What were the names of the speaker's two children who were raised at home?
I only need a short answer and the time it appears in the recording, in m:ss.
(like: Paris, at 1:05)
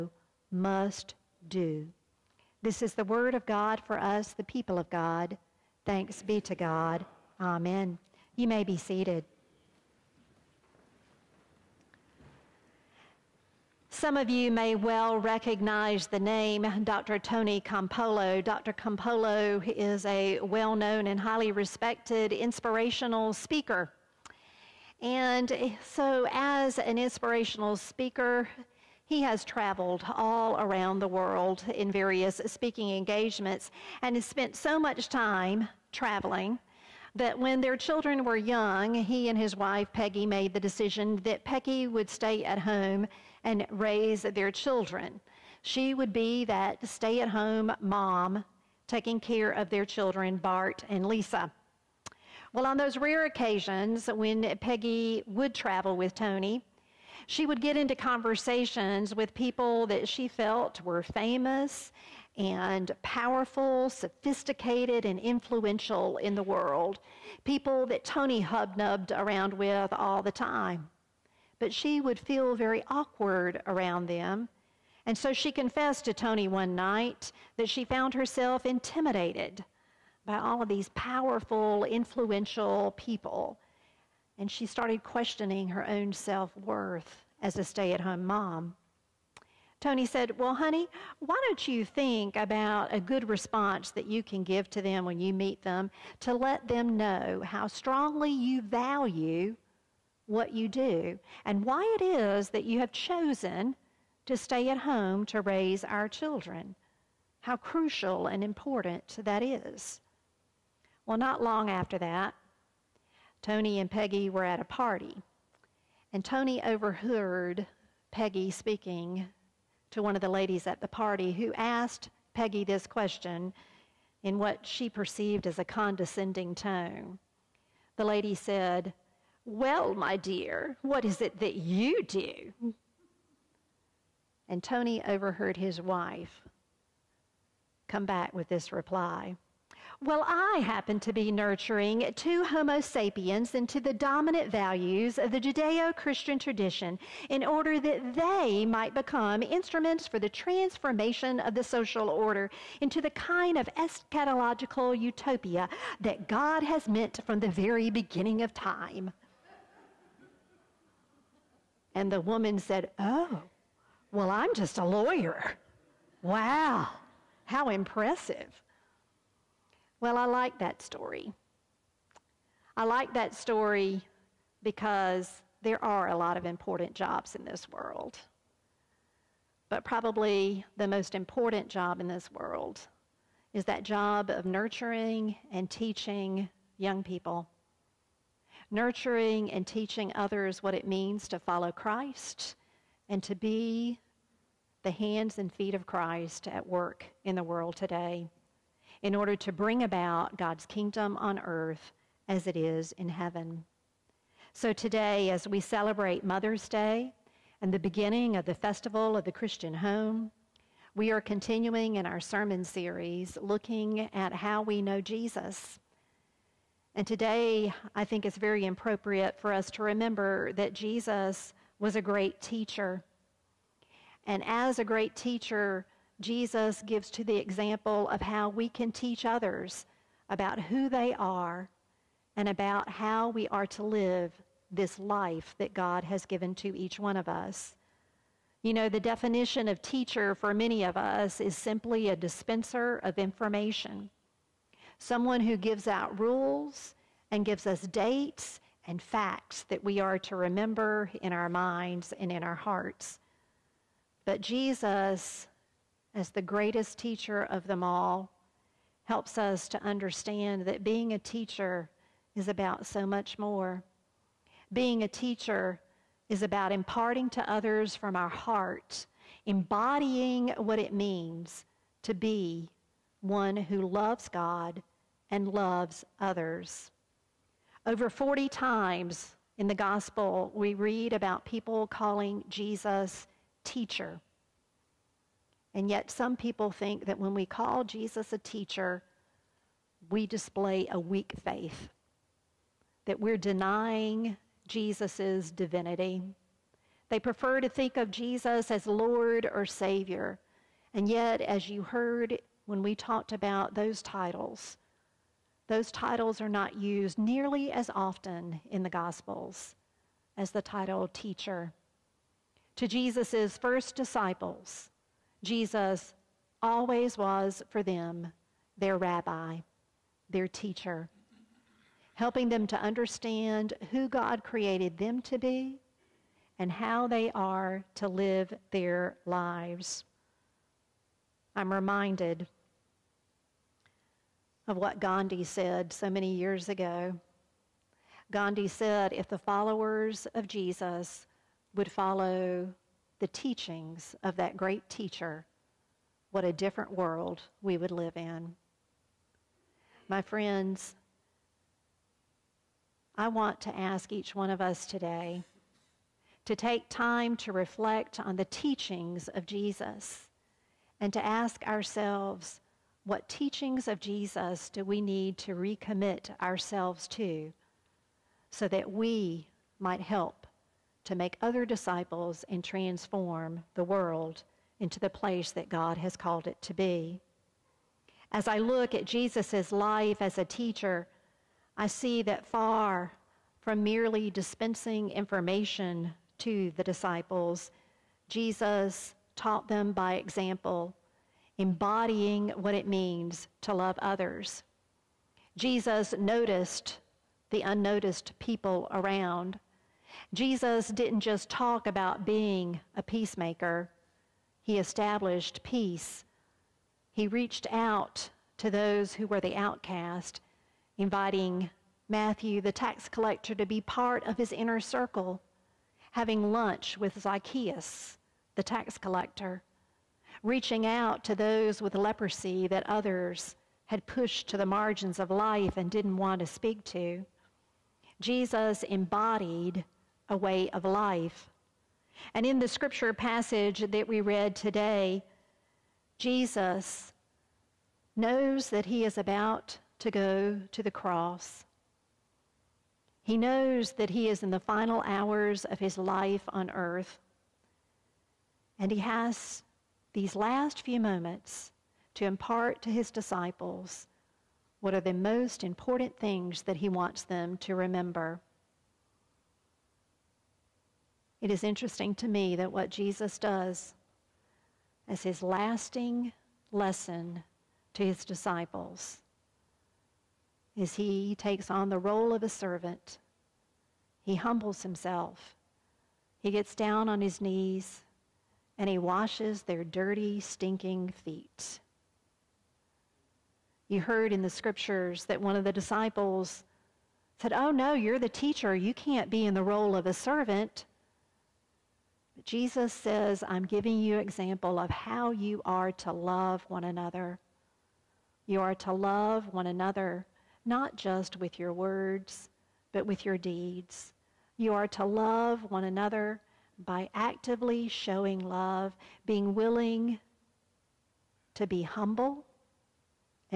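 Bart and Lisa, at 0:50.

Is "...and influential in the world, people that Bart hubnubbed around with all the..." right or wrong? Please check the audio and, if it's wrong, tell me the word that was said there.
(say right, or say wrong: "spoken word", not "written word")
wrong: "Tony", not "Bart".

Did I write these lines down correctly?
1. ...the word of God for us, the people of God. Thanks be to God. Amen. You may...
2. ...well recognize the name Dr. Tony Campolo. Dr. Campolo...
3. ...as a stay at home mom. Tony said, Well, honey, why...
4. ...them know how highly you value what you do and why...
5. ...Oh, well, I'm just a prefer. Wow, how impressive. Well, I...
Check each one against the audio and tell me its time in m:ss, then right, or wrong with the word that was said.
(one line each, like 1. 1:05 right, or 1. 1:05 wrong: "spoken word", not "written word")
1. 0:02 right
2. 0:14 right
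3. 1:27 right
4. 1:36 wrong: "strongly", not "highly"
5. 2:42 wrong: "lawyer", not "prefer".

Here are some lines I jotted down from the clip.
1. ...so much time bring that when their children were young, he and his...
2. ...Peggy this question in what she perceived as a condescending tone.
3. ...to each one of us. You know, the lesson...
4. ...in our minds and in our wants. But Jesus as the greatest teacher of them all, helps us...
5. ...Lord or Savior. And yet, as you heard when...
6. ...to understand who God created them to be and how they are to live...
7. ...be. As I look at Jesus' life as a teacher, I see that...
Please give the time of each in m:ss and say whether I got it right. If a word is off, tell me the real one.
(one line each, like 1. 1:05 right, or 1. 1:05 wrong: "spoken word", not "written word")
1. 0:34 wrong: "traveling", not "bring"
2. 2:02 right
3. 3:56 wrong: "definition", not "lesson"
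4. 4:11 wrong: "hearts", not "wants"
5. 4:58 right
6. 5:22 right
7. 6:16 right.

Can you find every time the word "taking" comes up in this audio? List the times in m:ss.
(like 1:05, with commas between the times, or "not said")
0:48.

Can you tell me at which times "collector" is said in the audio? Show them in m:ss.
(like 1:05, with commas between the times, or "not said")
6:53, 6:58.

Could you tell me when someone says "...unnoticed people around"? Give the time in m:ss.
6:37.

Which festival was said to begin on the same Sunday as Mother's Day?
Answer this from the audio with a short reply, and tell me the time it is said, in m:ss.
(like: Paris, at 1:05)
Festival of the Christian home, at 3:28.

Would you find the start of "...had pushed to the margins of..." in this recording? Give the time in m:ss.
7:03.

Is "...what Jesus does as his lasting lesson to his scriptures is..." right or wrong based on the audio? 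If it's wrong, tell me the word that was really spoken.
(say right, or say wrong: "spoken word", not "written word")
wrong: "disciples", not "scriptures".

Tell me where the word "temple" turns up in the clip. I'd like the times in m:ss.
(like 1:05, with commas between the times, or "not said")
not said.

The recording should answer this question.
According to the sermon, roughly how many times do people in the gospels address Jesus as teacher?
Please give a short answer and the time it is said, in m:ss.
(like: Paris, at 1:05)
Over 40, at 4:37.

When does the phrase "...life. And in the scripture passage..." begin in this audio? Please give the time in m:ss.
7:10.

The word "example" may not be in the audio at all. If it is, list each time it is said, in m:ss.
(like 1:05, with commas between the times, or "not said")
3:47, 6:30, 8:14.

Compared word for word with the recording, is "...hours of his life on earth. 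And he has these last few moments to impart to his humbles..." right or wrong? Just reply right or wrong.
wrong.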